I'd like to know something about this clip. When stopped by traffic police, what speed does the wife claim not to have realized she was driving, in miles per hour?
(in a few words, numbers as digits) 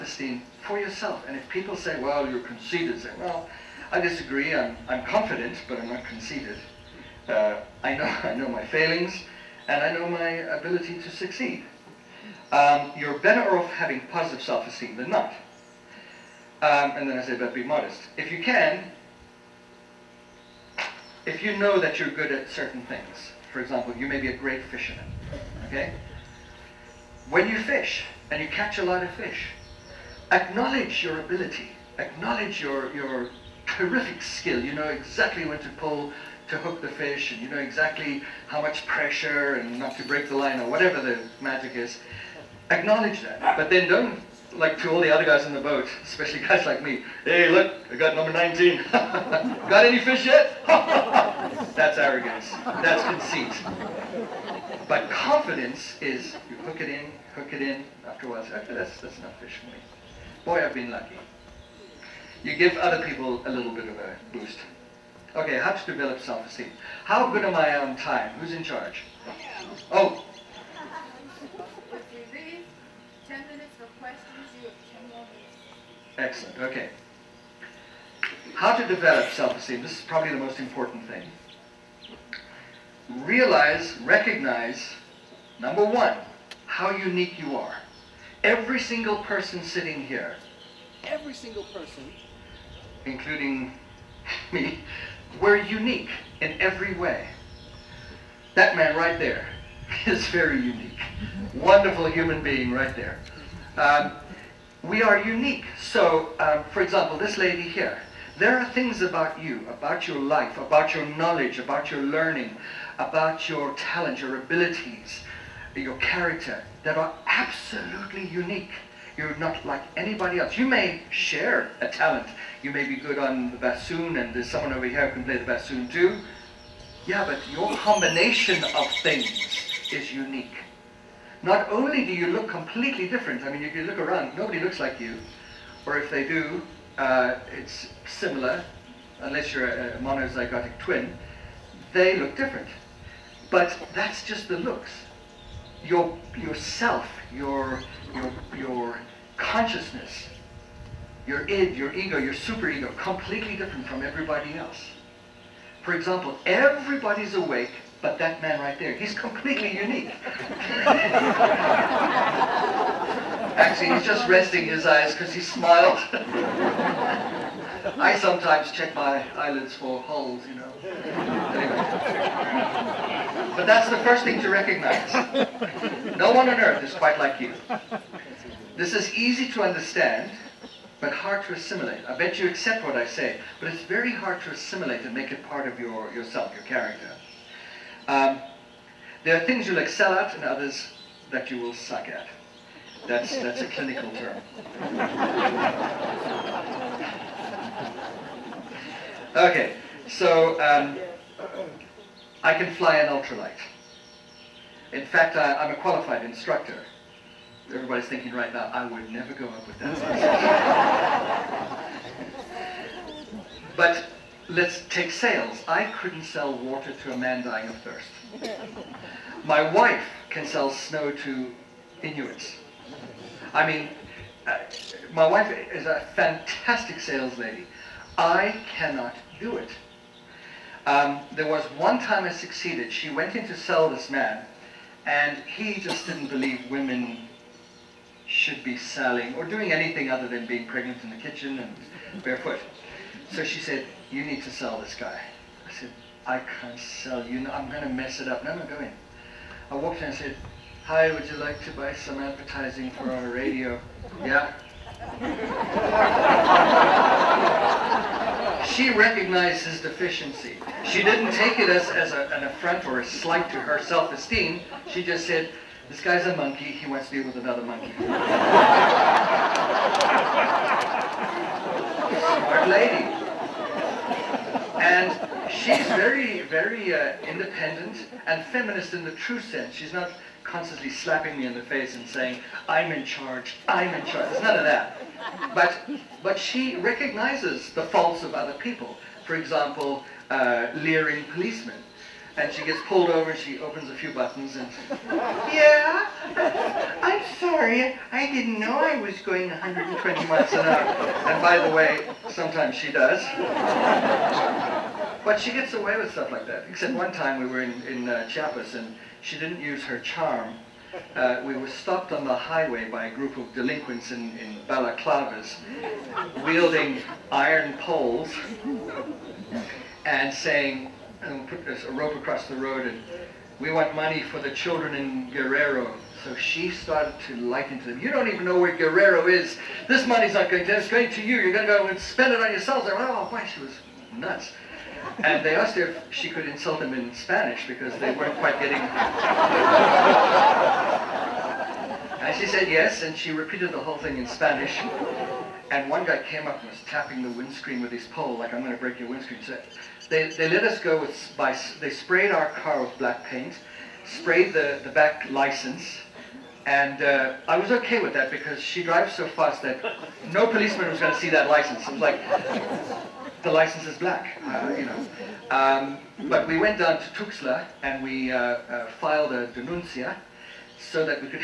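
120.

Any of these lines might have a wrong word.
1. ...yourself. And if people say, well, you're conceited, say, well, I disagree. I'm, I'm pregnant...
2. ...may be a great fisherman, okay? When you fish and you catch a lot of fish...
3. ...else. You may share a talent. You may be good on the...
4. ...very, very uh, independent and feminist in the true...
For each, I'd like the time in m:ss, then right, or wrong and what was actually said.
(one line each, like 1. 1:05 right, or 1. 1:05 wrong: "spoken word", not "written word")
1. 0:00 wrong: "confident", not "pregnant"
2. 0:24 right
3. 2:00 right
4. 4:35 right.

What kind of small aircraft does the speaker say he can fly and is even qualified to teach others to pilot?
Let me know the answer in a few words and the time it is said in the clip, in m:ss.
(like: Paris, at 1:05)
ultralight, at 3:23.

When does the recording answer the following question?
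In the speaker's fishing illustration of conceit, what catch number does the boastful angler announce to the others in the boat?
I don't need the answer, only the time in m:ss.
0:48.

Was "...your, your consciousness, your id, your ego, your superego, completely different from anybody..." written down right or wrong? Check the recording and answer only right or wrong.
wrong.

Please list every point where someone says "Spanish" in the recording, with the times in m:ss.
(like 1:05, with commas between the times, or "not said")
5:37, 5:44.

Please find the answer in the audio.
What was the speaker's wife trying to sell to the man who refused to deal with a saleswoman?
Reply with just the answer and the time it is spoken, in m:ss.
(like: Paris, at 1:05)
advertising for our radio, at 4:12.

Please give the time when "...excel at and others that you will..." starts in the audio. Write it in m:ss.
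3:09.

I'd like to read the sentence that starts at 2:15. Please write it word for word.
Or if they do, uh, it's similar, unless you're a, a monozygotic twin.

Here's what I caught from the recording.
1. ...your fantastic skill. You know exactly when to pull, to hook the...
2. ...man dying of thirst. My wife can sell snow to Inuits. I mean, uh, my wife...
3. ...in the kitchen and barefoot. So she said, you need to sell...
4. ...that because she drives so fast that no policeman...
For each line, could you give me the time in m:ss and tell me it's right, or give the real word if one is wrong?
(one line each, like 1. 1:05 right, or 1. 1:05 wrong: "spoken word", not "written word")
1. 0:32 wrong: "terrific", not "fantastic"
2. 3:37 right
3. 4:01 right
4. 5:58 right.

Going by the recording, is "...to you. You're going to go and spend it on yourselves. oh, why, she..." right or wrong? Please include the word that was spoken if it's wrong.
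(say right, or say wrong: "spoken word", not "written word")
right.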